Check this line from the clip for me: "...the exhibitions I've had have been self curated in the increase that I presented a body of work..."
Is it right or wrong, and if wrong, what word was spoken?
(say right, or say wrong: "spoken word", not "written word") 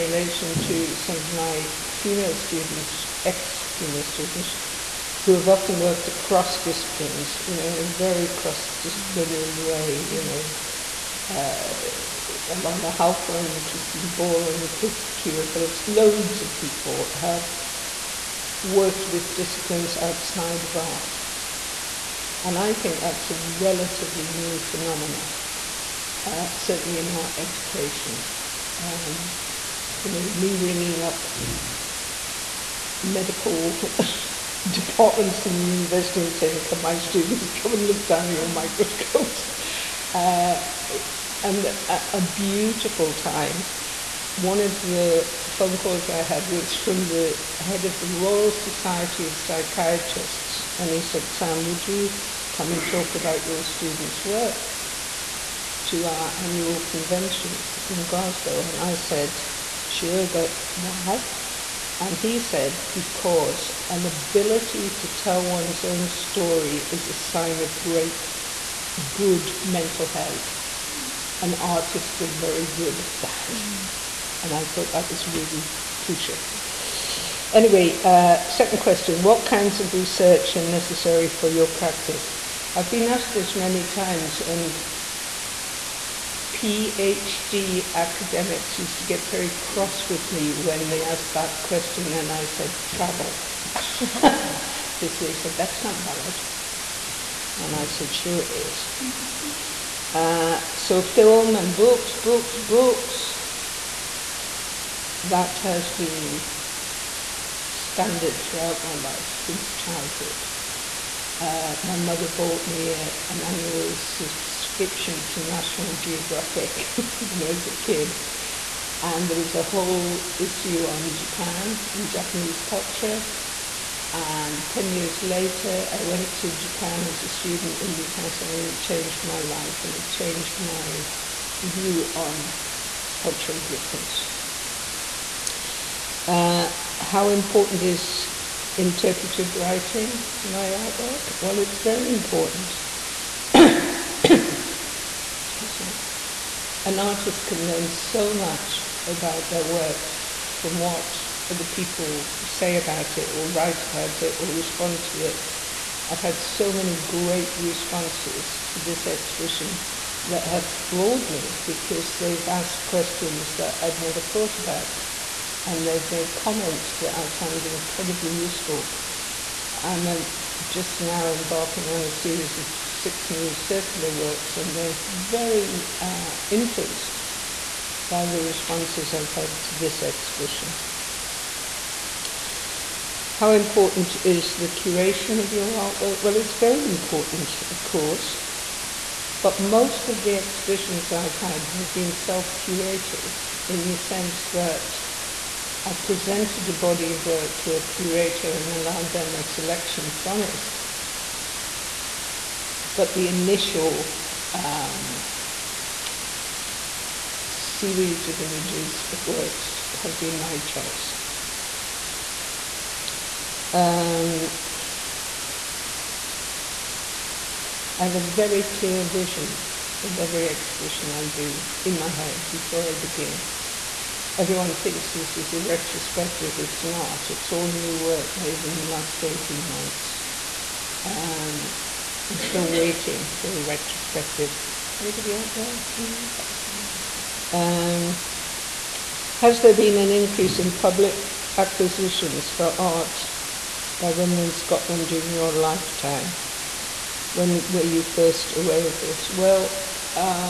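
wrong: "sense", not "increase".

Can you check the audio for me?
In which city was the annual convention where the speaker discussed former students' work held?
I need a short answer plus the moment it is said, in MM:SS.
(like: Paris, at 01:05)
Glasgow, at 00:58.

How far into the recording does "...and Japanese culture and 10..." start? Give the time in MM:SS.
02:01.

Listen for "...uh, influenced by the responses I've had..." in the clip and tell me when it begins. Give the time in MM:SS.
02:55.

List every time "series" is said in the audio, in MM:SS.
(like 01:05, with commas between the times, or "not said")
02:52, 03:27.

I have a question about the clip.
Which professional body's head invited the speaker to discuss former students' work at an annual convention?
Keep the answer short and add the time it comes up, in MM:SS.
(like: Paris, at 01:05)
Royal Society of Psychiatrists, at 00:48.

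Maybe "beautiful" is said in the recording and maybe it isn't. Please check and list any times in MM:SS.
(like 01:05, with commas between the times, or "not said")
00:42.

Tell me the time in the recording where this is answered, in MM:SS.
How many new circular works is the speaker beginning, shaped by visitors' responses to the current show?
02:52.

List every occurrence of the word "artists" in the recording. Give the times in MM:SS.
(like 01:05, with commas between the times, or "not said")
01:11, 02:26.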